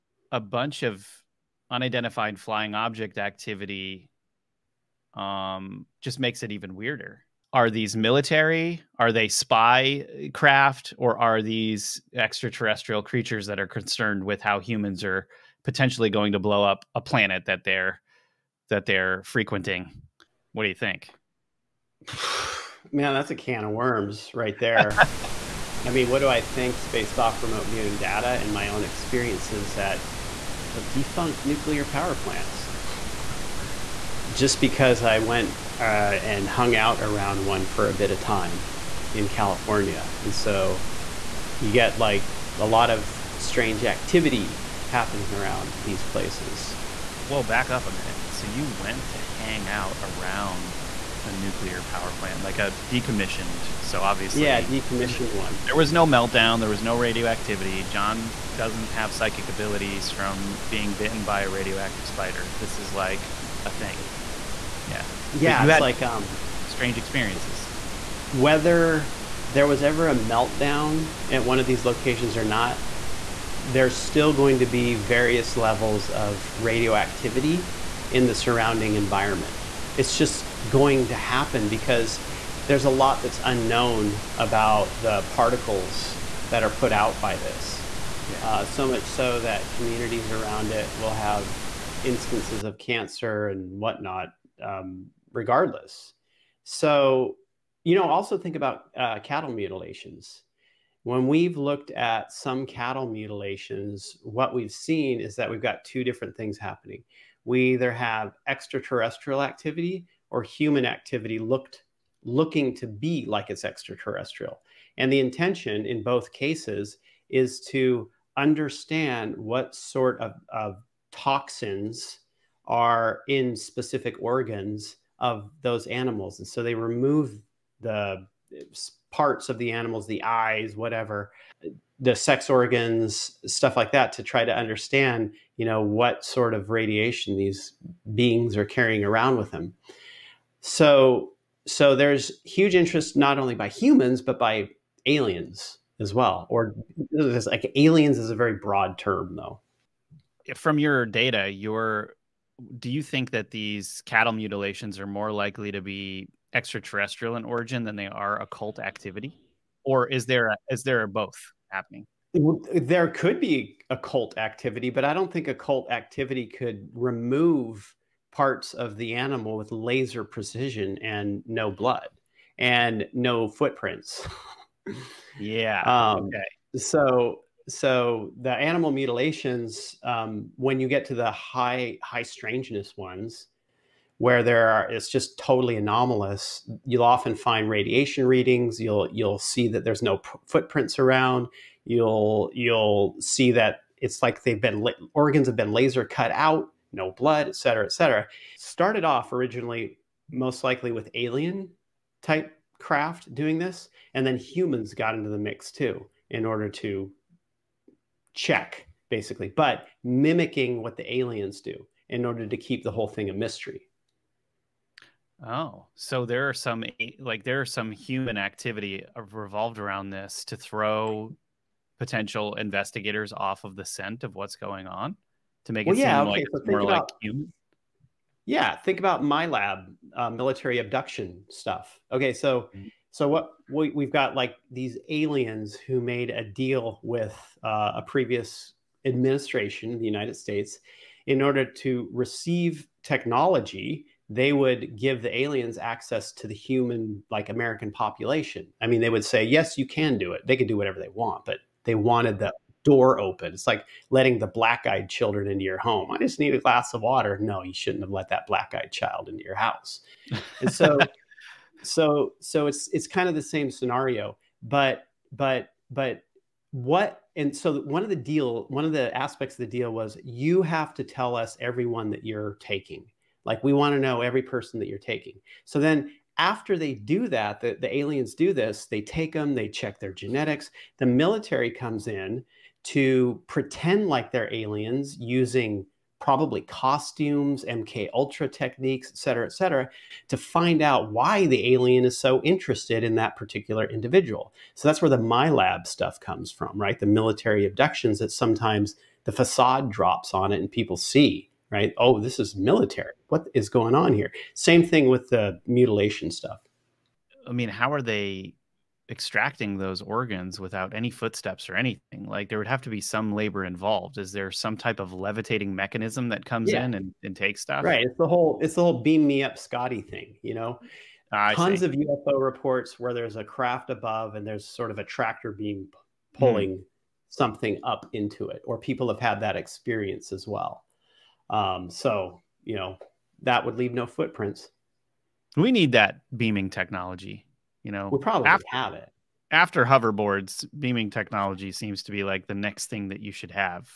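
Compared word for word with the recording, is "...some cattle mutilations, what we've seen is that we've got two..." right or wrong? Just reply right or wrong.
right.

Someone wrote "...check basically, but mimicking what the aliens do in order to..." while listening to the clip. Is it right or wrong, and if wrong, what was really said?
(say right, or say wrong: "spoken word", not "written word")
right.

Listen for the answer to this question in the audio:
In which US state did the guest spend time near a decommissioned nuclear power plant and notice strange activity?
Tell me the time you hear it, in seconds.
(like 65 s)
39 s.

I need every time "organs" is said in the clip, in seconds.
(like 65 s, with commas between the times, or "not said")
124 s, 132 s, 195 s, 310 s.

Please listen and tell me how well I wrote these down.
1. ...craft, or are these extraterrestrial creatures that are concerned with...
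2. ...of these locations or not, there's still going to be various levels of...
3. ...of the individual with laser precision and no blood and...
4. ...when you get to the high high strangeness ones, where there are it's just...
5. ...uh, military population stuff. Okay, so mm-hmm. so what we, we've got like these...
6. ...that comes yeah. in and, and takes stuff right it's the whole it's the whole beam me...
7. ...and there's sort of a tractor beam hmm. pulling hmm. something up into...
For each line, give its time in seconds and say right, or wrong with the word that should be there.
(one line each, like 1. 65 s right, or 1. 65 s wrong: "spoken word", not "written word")
1. 10 s right
2. 71 s right
3. 168 s wrong: "animal", not "individual"
4. 180 s right
5. 230 s wrong: "abduction", not "population"
6. 316 s right
7. 324 s right.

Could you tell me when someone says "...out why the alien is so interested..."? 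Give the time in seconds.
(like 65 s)
290 s.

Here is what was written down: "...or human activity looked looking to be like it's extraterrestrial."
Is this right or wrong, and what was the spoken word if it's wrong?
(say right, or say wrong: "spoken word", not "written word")
right.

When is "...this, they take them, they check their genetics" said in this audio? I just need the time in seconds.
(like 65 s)
278 s.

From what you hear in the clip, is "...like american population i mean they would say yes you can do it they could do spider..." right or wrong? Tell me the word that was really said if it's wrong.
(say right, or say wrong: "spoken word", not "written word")
wrong: "whatever", not "spider".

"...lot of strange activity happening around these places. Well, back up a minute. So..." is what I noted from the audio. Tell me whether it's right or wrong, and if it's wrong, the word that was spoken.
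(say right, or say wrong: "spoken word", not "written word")
right.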